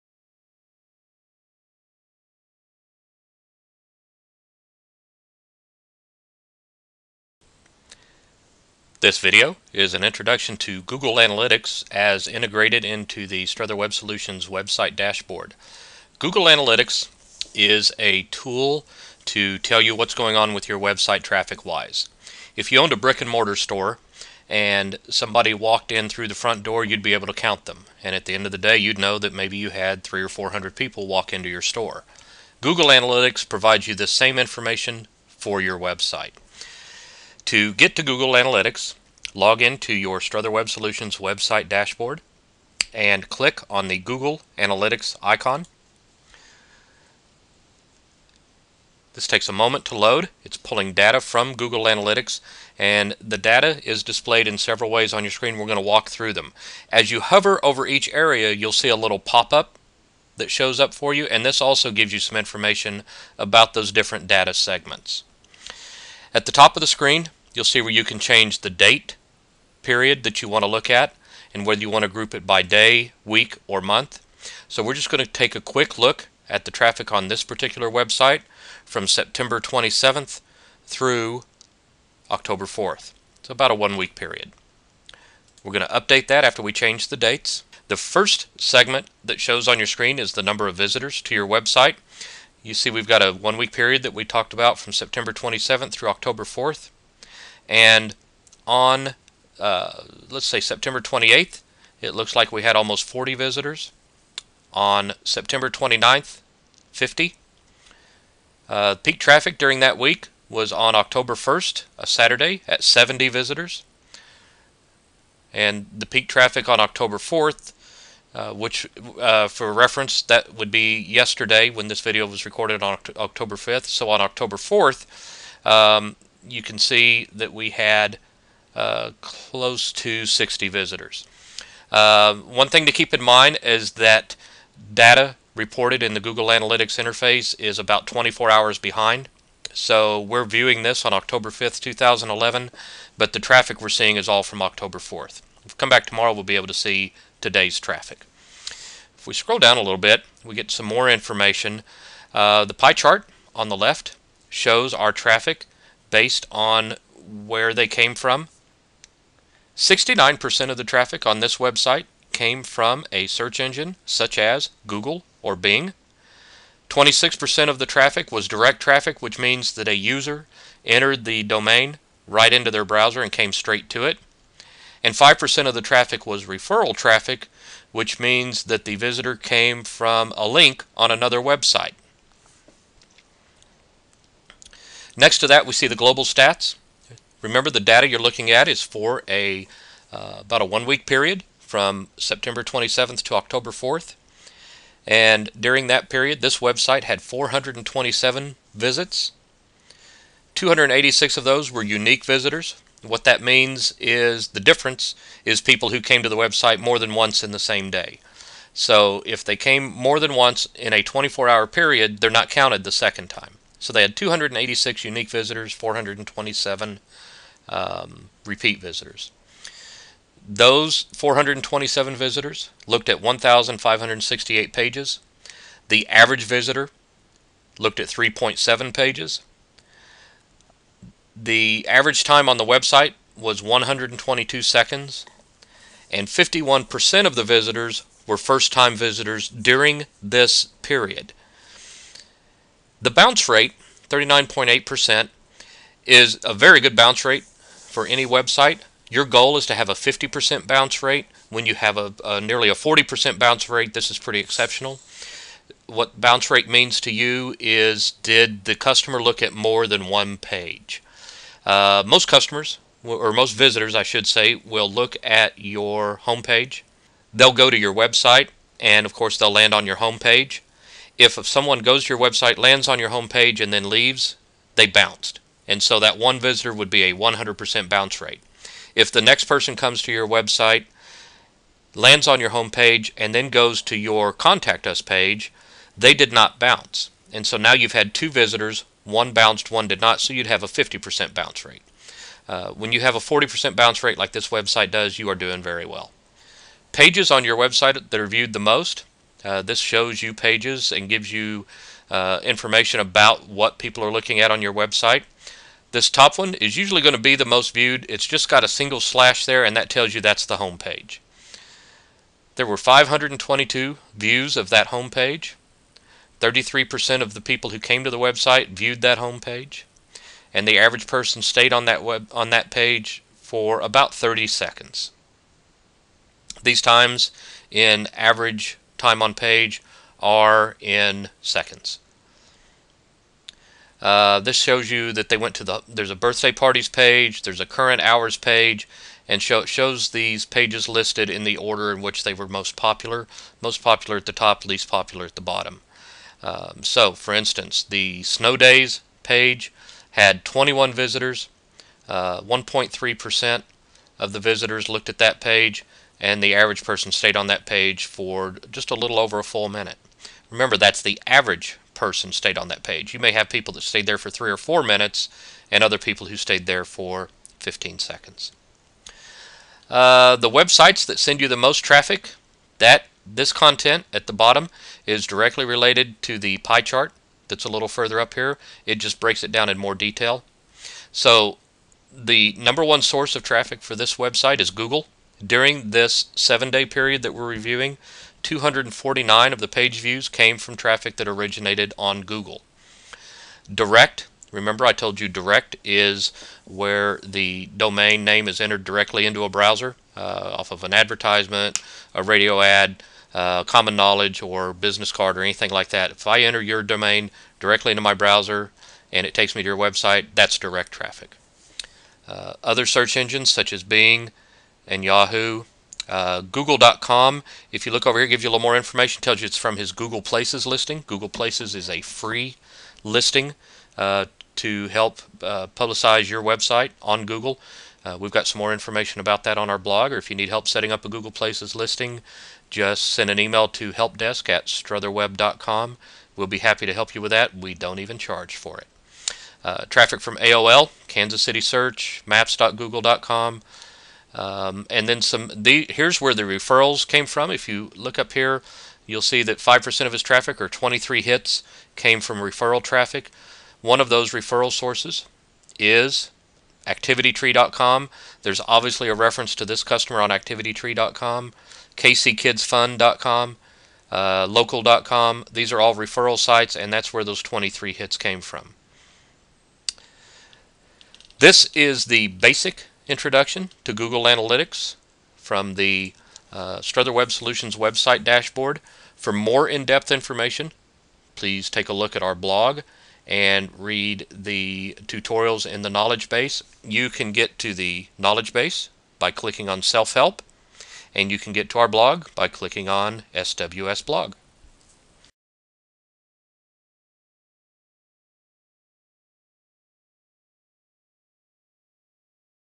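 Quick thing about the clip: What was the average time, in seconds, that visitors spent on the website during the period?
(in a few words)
122 seconds.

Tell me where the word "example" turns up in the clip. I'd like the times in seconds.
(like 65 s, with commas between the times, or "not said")
not said.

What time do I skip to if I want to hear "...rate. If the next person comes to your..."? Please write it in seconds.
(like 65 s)
278 s.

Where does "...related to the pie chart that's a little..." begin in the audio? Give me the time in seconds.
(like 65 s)
375 s.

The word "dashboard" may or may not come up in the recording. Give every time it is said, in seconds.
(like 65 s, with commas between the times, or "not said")
14 s, 41 s, 478 s.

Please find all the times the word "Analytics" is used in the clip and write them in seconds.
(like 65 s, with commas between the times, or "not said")
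11 s, 16 s, 32 s, 38 s, 44 s, 51 s, 136 s, 474 s.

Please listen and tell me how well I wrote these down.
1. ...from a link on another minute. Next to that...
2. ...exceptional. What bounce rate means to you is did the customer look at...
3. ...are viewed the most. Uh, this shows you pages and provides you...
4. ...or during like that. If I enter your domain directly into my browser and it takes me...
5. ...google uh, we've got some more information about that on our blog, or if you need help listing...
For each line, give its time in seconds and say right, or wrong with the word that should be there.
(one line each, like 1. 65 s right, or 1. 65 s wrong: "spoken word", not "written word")
1. 179 s wrong: "website", not "minute"
2. 254 s right
3. 298 s wrong: "gives", not "provides"
4. 405 s wrong: "anything", not "during"
5. 427 s wrong: "setting", not "listing".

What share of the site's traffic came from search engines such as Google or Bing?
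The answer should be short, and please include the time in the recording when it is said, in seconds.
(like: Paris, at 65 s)
69%, at 159 s.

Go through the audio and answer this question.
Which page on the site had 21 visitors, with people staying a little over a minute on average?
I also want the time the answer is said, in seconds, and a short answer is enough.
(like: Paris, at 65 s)
snow days page, at 348 s.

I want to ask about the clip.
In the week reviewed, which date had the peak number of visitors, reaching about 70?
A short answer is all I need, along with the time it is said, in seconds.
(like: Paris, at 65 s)
October 1st, at 110 s.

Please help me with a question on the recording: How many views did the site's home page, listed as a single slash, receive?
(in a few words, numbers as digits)
522.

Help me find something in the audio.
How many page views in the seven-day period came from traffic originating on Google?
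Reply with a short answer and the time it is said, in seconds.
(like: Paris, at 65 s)
249, at 388 s.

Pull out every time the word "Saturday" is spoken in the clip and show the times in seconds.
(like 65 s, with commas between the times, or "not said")
112 s.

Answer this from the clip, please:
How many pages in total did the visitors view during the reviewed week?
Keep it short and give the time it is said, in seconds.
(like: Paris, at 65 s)
1,568, at 223 s.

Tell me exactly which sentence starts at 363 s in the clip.
You may have people that stayed there for three or four minutes, and other people who stayed there for 15 seconds.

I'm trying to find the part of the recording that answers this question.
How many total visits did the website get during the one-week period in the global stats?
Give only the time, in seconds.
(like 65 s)
197 s.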